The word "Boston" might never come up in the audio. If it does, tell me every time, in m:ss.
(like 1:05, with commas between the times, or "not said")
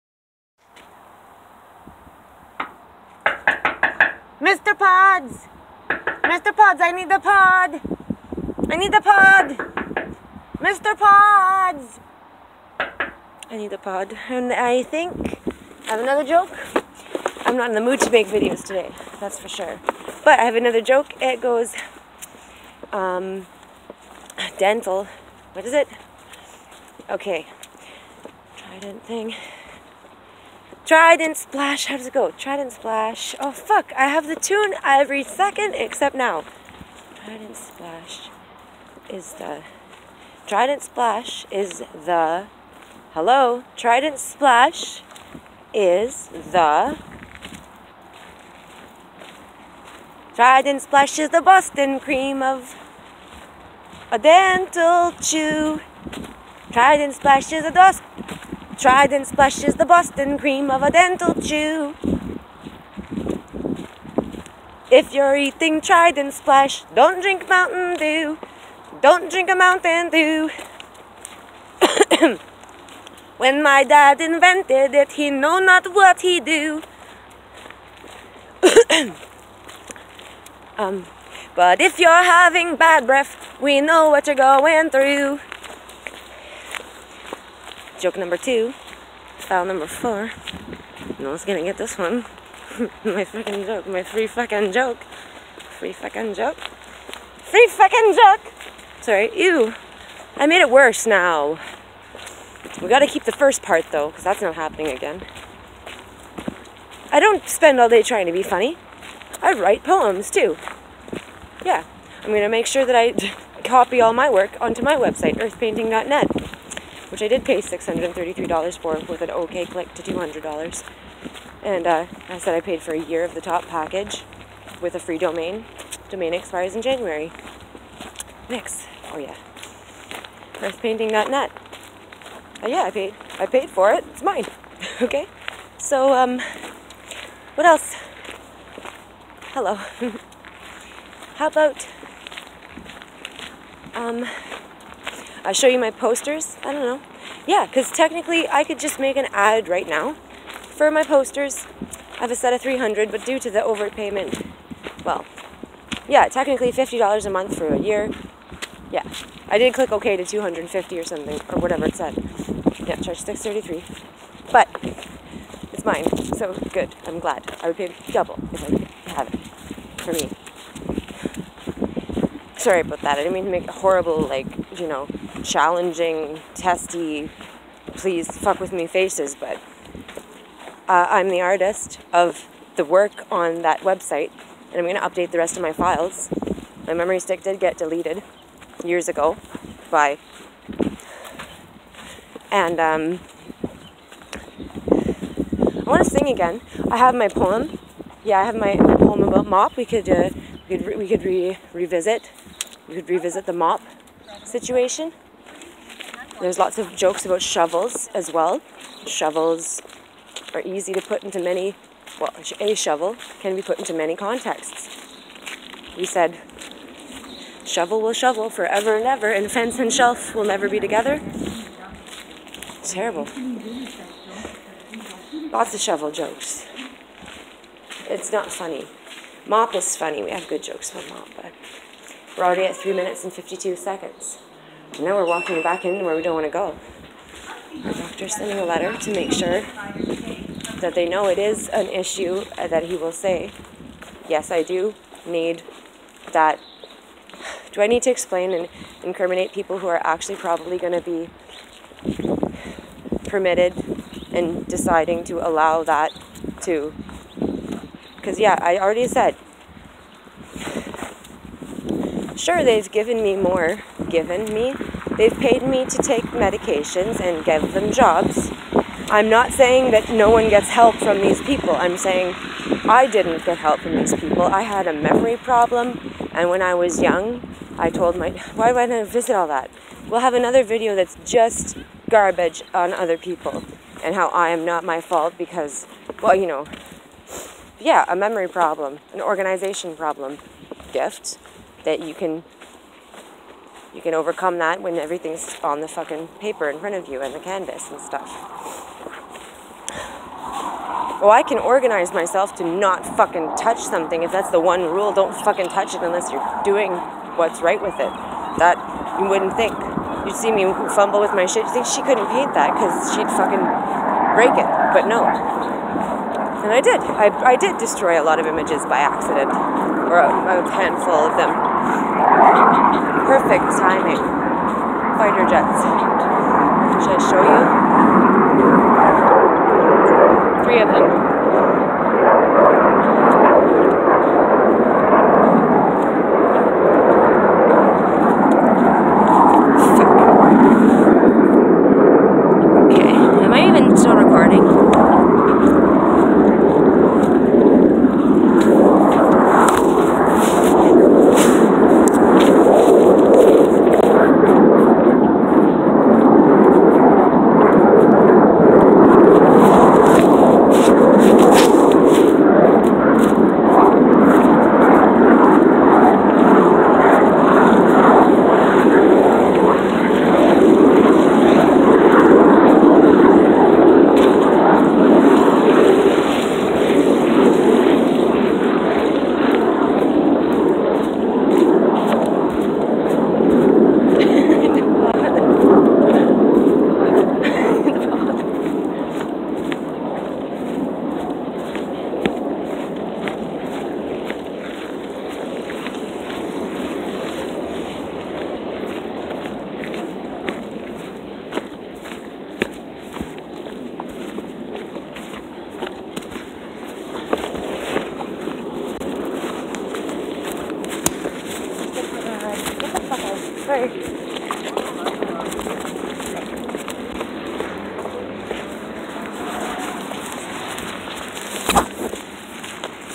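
0:51, 0:59.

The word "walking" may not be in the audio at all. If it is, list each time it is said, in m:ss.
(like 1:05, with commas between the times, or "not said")
3:55.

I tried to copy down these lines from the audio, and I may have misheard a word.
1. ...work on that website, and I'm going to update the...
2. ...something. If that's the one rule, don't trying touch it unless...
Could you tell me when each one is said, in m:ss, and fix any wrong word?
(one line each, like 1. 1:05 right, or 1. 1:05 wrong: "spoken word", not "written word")
1. 3:02 right
2. 5:03 wrong: "fucking", not "trying".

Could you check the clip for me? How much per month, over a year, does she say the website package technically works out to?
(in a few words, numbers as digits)
$50.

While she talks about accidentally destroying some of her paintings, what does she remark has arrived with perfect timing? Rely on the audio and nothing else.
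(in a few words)
Fighter jets.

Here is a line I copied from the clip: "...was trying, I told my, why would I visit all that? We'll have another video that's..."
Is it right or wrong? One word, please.
wrong.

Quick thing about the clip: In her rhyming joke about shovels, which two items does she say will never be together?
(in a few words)
fence and shelf.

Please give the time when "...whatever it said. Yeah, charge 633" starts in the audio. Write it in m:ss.
2:41.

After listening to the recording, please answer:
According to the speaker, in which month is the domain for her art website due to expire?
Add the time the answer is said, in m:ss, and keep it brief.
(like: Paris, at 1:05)
January, at 2:06.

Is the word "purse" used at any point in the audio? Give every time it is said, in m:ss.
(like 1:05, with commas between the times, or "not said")
not said.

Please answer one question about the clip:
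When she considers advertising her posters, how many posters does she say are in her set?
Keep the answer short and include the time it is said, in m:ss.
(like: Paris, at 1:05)
300, at 2:32.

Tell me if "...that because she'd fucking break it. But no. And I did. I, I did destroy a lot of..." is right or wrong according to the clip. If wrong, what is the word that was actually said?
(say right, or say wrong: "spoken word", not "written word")
right.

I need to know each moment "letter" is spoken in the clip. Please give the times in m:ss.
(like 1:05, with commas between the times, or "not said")
3:58.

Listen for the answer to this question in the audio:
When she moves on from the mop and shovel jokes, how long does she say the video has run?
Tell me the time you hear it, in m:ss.
3:52.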